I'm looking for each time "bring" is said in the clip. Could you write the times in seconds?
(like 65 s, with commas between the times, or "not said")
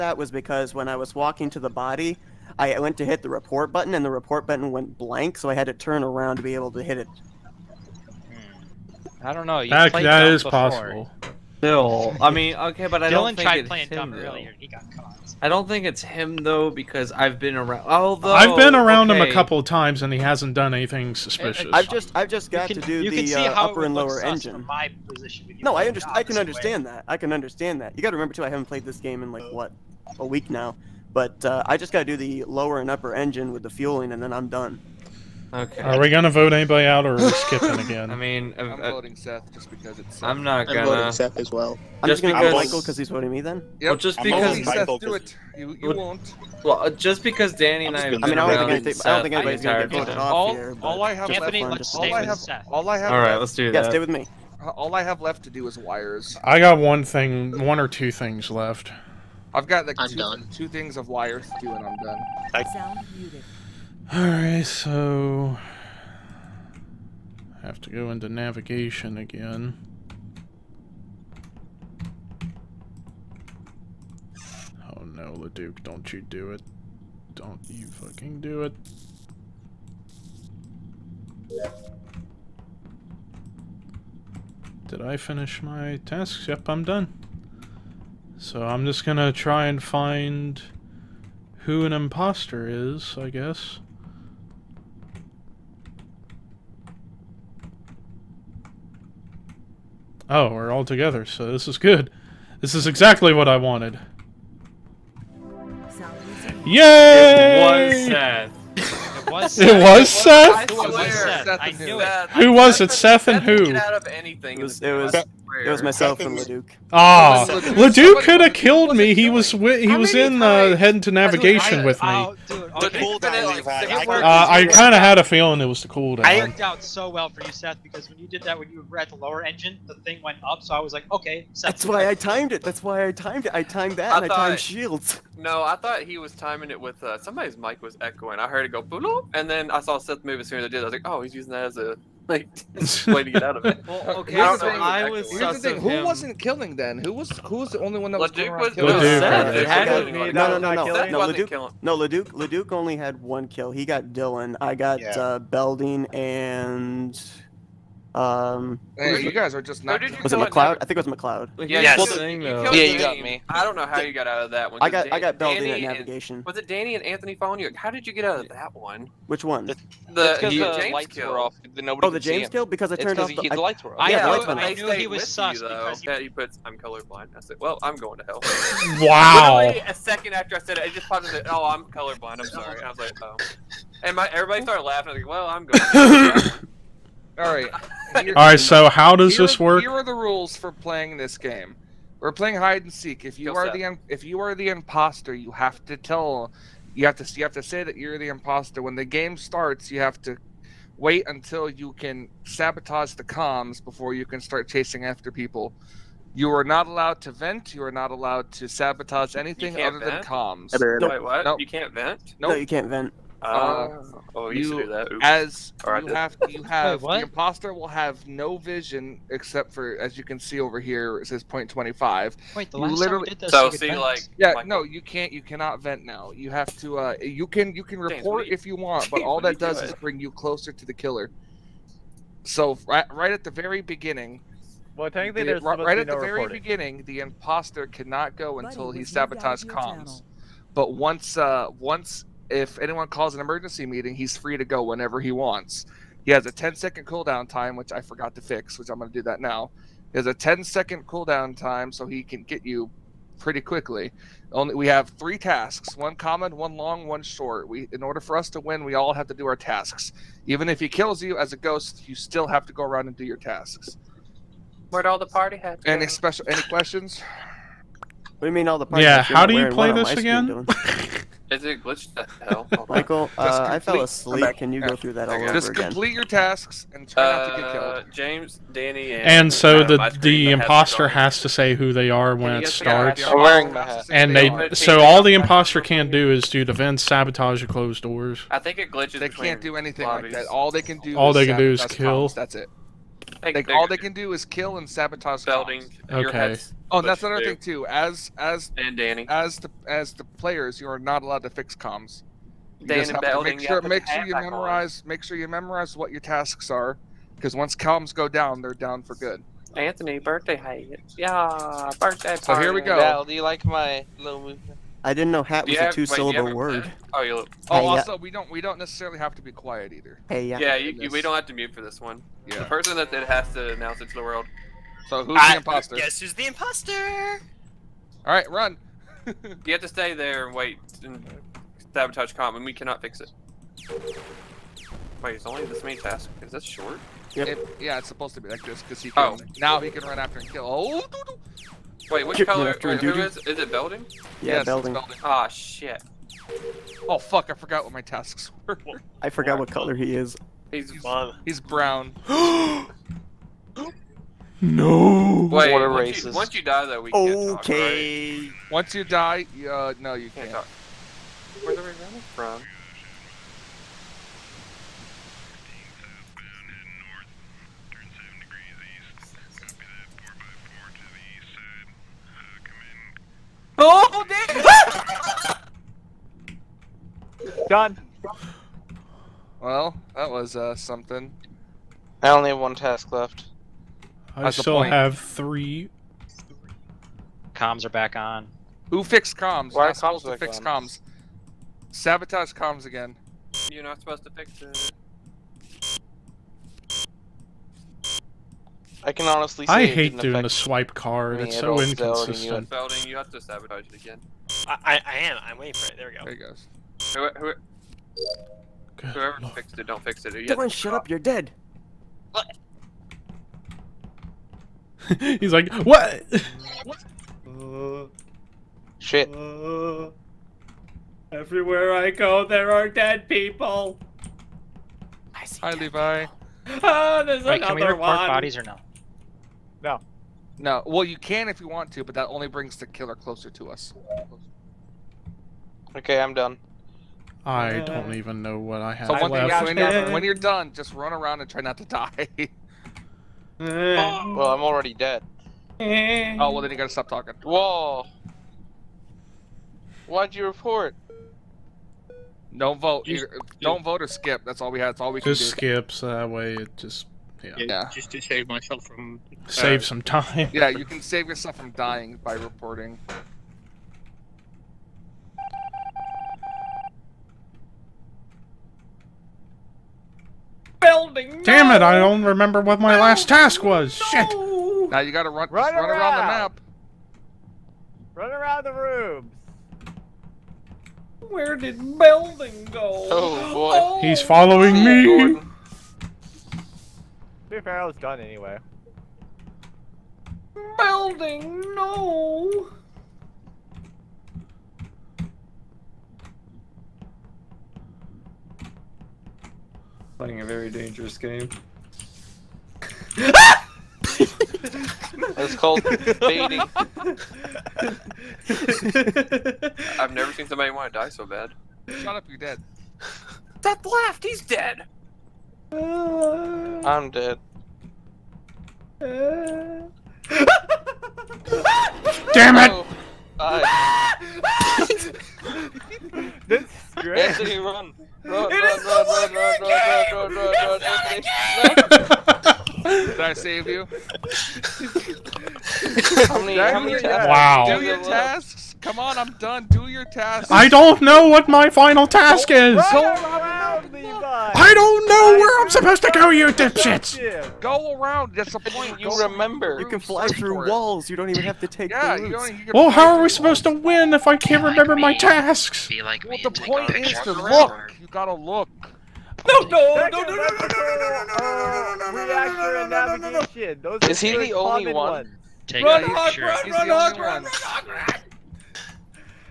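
229 s, 432 s.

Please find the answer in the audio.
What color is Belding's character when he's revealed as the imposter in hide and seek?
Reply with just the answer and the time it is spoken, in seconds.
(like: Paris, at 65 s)
brown, at 351 s.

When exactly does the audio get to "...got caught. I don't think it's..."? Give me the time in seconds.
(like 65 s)
14 s.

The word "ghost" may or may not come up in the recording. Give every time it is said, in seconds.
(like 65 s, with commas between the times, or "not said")
261 s.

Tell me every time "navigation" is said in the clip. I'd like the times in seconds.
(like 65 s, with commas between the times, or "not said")
68 s, 121 s, 165 s.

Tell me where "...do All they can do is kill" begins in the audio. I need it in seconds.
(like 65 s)
290 s.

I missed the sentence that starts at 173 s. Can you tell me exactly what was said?
I, yeah, I, I knew he was sus you, because yeah, he puts I'm colorblind.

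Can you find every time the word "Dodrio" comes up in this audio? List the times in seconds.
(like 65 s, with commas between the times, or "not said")
not said.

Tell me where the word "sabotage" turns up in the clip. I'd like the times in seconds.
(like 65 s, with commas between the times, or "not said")
202 s, 208 s, 239 s, 287 s, 294 s, 331 s, 391 s, 403 s.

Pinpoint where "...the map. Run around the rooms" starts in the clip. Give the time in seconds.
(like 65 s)
476 s.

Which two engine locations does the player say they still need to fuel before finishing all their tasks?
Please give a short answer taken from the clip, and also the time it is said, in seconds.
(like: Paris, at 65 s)
lower and upper engine, at 32 s.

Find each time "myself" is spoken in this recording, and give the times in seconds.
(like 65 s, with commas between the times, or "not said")
115 s, 458 s.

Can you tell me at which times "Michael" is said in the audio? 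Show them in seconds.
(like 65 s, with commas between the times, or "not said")
42 s, 272 s.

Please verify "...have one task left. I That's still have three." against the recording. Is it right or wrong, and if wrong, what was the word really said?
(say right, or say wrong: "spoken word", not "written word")
right.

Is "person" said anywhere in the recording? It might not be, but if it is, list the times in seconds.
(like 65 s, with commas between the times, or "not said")
322 s.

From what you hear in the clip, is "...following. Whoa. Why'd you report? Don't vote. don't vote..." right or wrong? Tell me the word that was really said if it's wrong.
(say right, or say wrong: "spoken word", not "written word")
wrong: "talking", not "following".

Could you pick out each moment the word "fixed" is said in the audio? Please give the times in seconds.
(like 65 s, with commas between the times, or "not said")
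389 s, 409 s.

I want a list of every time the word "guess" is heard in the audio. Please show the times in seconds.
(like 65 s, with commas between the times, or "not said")
93 s, 325 s.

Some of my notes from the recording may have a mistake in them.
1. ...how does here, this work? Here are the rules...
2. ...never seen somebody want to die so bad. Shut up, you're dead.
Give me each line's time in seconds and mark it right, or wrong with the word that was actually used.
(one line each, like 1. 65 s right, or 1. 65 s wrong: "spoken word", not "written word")
1. 188 s right
2. 510 s right.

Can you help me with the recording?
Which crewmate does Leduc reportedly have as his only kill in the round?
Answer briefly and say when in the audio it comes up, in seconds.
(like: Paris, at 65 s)
Dillon, at 154 s.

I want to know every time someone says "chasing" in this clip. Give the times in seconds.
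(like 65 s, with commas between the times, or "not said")
204 s.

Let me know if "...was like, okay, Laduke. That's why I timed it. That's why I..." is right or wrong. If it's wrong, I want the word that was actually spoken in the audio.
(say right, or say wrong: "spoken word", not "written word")
wrong: "Seth", not "Laduke".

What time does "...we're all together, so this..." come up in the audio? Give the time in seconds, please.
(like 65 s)
100 s.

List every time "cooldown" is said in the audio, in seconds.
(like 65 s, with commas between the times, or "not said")
125 s, 247 s, 251 s.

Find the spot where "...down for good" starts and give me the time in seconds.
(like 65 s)
308 s.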